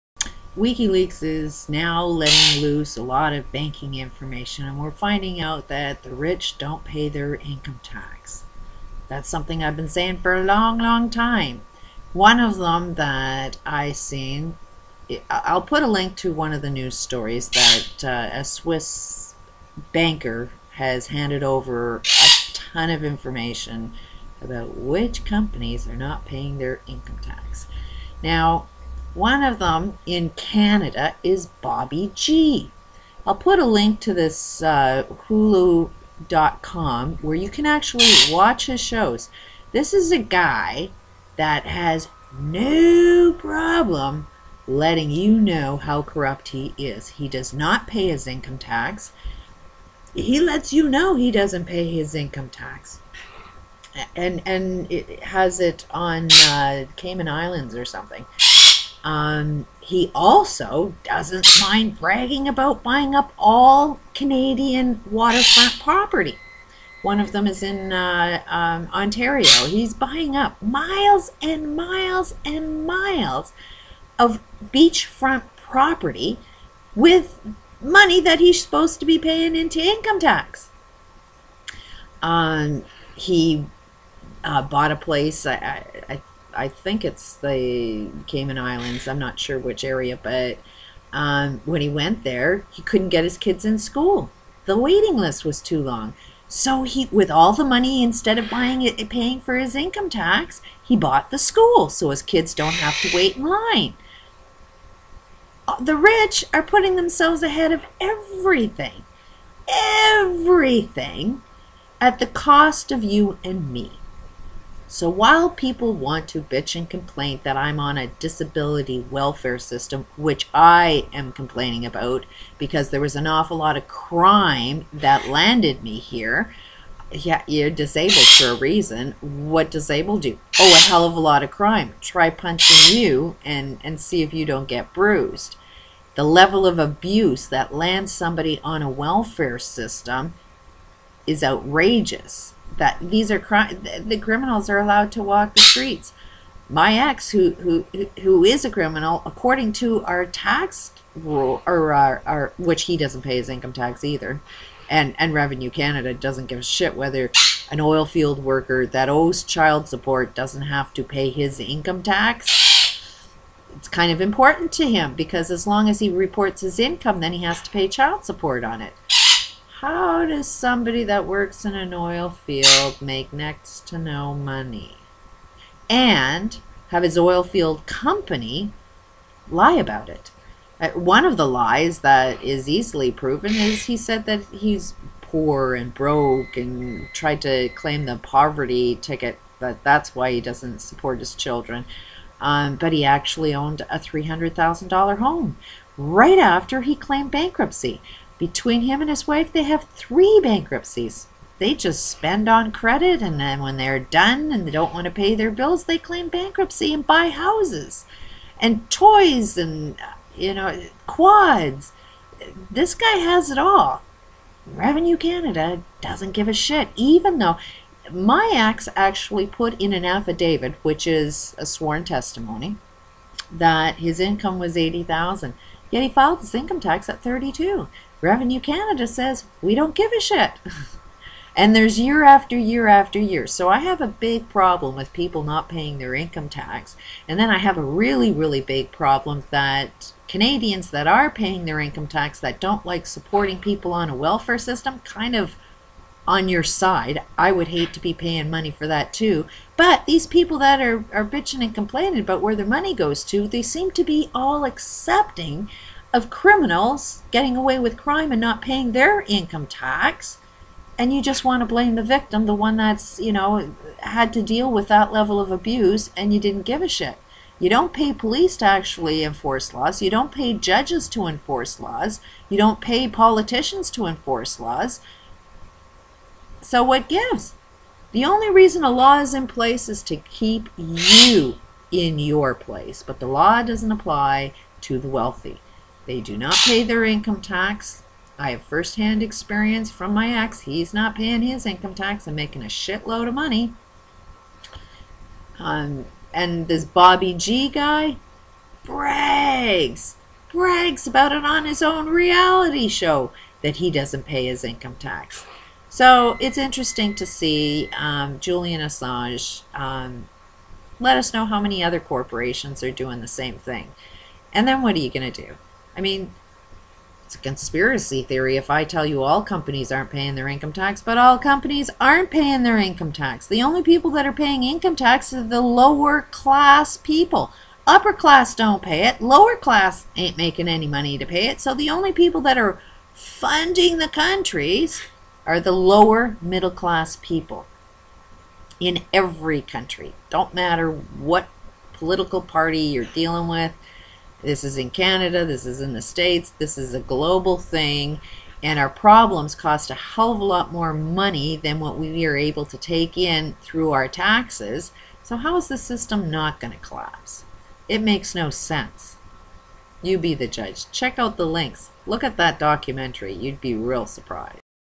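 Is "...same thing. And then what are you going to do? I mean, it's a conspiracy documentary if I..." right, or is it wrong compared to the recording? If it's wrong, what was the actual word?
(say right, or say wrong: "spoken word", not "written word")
wrong: "theory", not "documentary".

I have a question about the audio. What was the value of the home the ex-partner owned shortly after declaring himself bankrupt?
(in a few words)
$300,000.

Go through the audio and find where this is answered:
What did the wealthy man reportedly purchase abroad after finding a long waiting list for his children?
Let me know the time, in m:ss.
1:41.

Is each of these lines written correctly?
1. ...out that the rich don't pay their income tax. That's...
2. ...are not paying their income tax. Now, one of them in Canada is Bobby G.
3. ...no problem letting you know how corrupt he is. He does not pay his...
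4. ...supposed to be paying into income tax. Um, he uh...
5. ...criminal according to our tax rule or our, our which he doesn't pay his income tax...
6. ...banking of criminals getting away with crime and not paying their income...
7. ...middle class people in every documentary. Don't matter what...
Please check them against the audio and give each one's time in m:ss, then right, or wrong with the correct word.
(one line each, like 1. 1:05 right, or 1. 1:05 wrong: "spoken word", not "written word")
1. 0:05 right
2. 0:25 right
3. 0:42 right
4. 1:18 right
5. 2:28 right
6. 4:14 wrong: "accepting", not "banking"
7. 5:36 wrong: "country", not "documentary".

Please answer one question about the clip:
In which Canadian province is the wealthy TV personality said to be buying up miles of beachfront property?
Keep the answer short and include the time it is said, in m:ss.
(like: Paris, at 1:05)
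Ontario, at 1:08.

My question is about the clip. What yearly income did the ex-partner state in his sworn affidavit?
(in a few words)
80000.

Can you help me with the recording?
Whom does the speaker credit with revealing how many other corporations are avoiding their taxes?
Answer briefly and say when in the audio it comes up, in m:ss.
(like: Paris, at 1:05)
Julian Assange, at 5:08.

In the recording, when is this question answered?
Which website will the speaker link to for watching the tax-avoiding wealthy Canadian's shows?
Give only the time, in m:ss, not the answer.
0:35.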